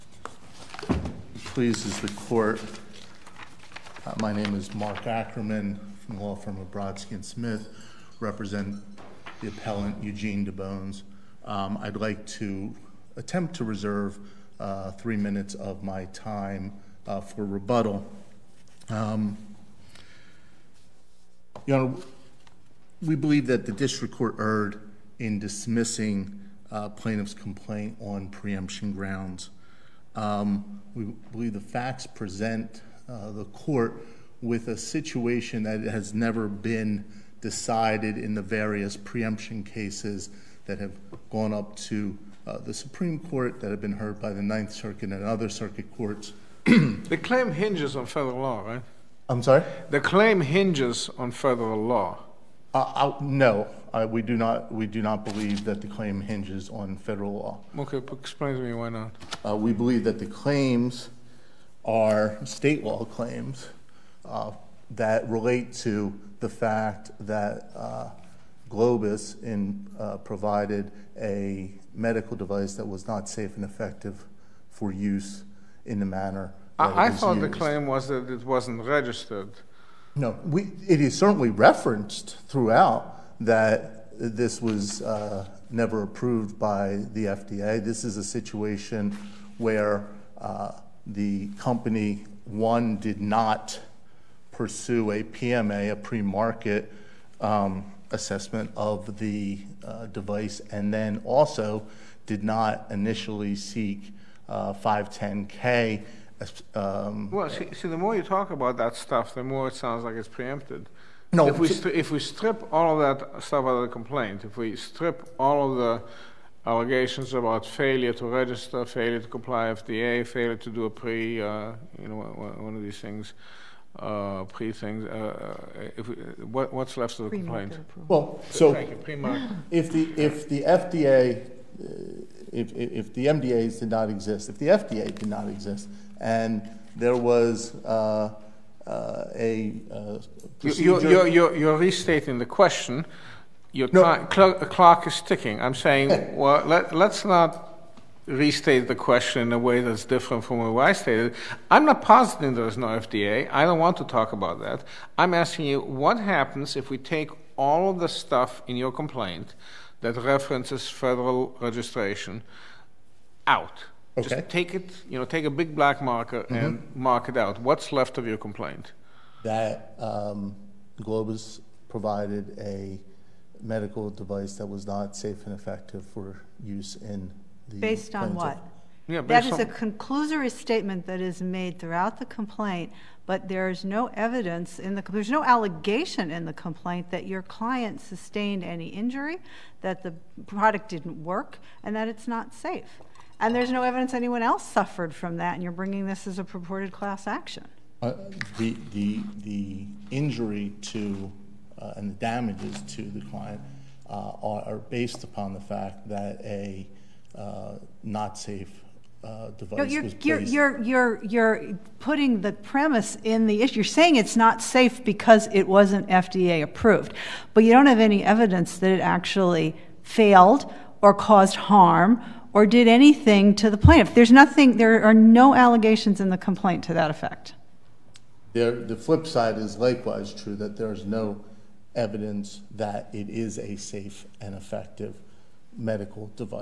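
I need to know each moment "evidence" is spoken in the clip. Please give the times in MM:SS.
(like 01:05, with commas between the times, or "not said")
03:04, 03:13, 03:38, 03:51.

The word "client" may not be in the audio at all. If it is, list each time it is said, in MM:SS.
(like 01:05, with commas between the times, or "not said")
03:07, 03:23.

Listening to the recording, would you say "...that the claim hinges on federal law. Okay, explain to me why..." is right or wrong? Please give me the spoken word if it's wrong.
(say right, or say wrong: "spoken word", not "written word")
right.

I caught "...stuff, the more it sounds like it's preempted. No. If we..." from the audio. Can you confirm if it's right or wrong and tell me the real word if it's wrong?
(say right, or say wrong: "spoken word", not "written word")
right.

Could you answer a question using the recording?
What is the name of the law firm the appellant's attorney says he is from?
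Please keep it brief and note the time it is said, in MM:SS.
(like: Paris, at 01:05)
Brodsky and Smith, at 00:06.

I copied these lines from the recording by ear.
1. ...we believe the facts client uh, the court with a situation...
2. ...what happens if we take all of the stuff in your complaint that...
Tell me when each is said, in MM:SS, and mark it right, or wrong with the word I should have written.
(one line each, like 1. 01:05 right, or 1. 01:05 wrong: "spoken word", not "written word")
1. 00:30 wrong: "present", not "client"
2. 02:35 right.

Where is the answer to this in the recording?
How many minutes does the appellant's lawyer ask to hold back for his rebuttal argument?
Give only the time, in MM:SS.
00:14.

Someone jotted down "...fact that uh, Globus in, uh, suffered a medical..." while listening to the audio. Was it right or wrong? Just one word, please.
wrong.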